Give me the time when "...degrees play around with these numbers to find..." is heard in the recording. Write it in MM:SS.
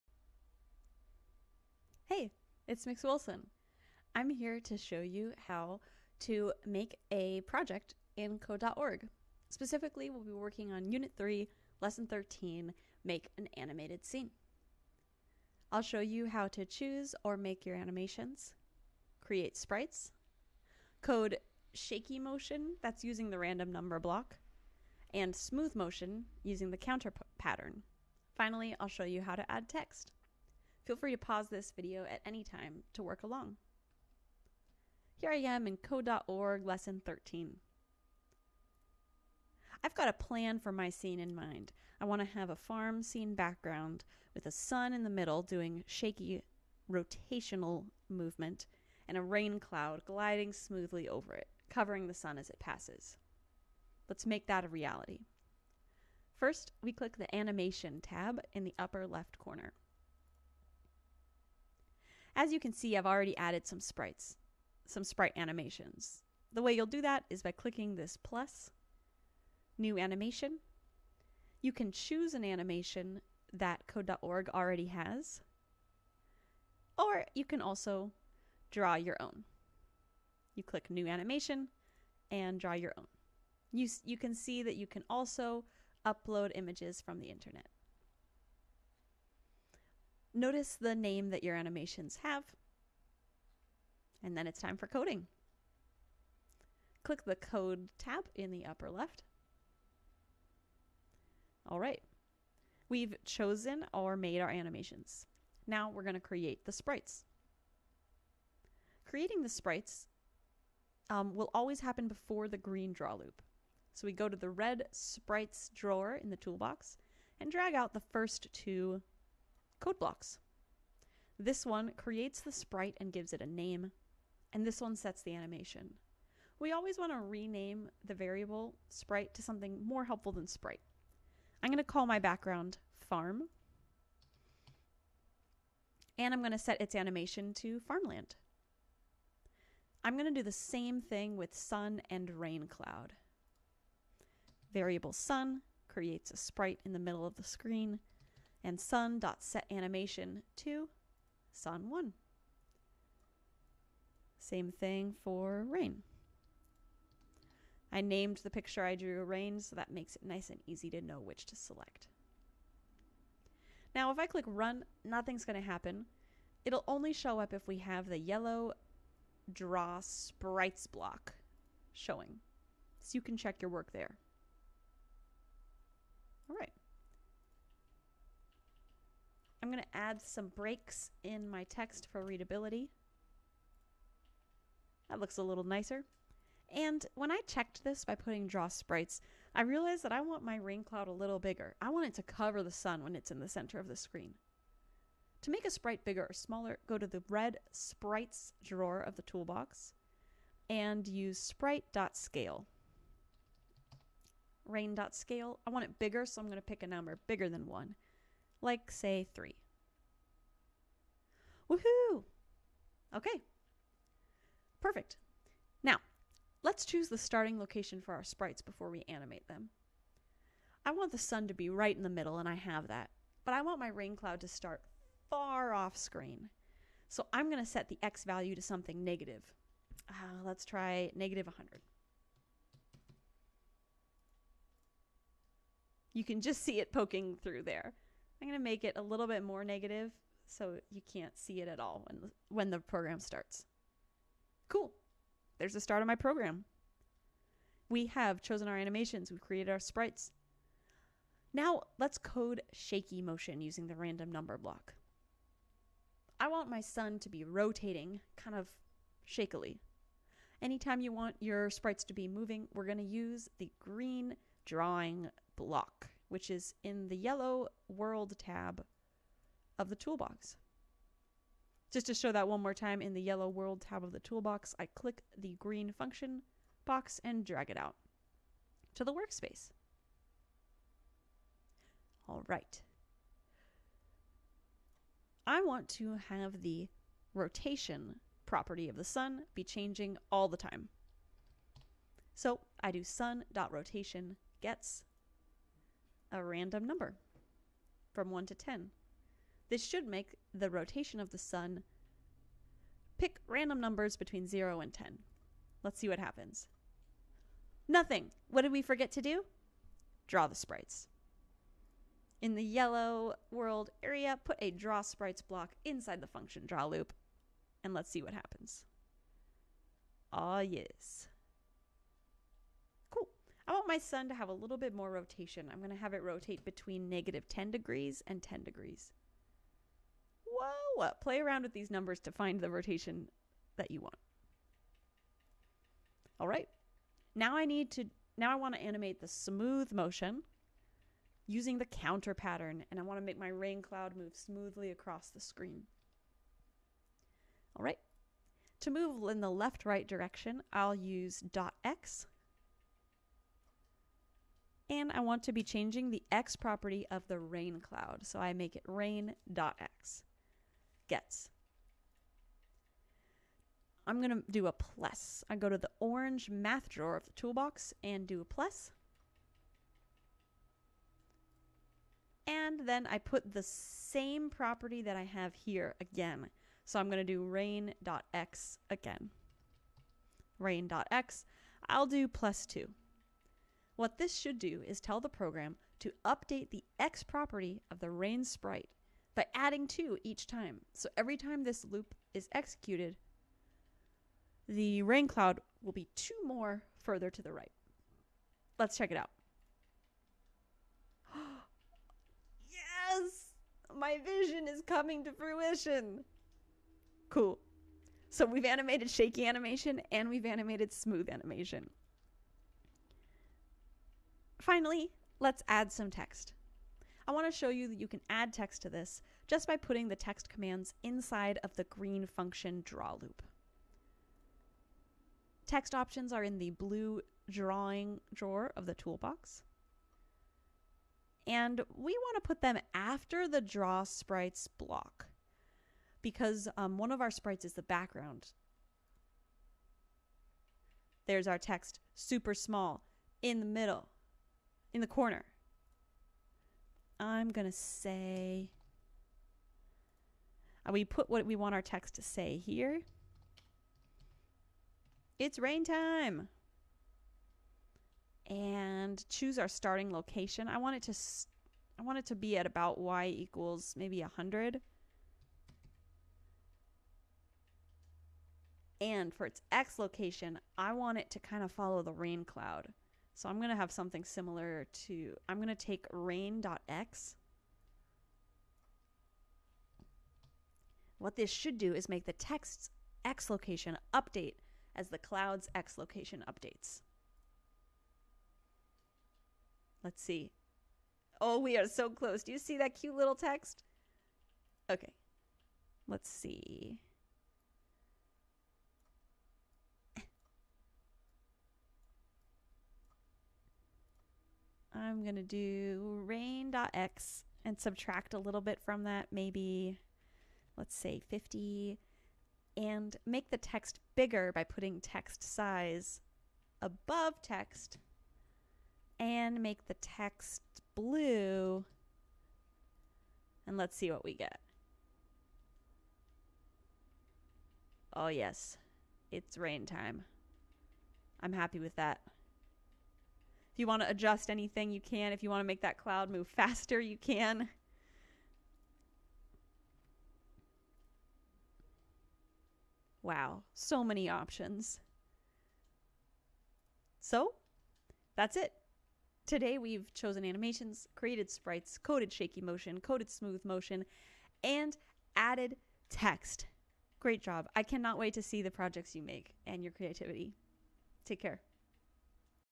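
05:28.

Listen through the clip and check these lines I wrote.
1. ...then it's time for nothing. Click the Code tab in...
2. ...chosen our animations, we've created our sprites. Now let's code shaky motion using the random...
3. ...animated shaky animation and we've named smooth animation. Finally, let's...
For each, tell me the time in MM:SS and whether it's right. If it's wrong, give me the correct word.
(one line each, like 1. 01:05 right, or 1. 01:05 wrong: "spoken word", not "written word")
1. 01:34 wrong: "coding", not "nothing"
2. 04:08 right
3. 06:48 wrong: "animated", not "named".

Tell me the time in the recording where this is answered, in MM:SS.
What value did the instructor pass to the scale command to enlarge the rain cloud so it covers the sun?
03:29.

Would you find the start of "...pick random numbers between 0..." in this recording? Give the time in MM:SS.
05:03.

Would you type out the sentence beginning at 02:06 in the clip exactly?
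We always want to rename the variable sprite to something more helpful than sprite.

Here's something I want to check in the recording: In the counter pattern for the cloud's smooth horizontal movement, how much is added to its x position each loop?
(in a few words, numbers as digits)
2.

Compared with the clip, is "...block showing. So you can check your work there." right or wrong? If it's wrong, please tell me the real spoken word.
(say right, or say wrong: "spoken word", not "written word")
right.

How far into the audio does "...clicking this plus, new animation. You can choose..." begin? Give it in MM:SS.
01:07.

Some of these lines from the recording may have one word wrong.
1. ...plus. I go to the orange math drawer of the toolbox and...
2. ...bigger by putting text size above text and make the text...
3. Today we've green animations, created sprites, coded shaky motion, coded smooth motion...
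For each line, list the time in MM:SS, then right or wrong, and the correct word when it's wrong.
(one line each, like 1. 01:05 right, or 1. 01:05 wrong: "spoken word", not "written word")
1. 06:04 right
2. 08:34 right
3. 09:09 wrong: "chosen", not "green".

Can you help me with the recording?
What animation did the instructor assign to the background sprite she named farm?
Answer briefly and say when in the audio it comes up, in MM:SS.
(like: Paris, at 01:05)
farmland, at 02:17.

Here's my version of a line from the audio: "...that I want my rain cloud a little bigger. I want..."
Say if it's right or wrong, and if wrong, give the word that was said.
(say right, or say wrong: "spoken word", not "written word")
right.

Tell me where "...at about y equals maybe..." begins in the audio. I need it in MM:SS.
07:42.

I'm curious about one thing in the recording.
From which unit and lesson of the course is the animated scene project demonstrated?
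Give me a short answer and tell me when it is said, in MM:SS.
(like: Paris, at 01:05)
Unit 3, Lesson 13, at 00:10.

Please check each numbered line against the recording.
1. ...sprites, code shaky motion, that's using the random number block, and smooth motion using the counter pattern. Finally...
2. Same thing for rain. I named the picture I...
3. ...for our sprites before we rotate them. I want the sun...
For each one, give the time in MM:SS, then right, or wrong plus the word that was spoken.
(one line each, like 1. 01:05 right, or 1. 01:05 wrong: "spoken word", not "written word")
1. 00:19 right
2. 02:34 right
3. 03:38 wrong: "animate", not "rotate".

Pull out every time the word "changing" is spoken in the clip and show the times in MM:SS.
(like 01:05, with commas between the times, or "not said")
04:49, 05:55.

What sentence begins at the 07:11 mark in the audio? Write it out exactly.
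And we want to put them after the draw sprites block because um, one of our sprites is the background.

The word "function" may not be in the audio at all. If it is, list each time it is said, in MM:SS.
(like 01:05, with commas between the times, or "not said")
04:35, 05:16, 07:02.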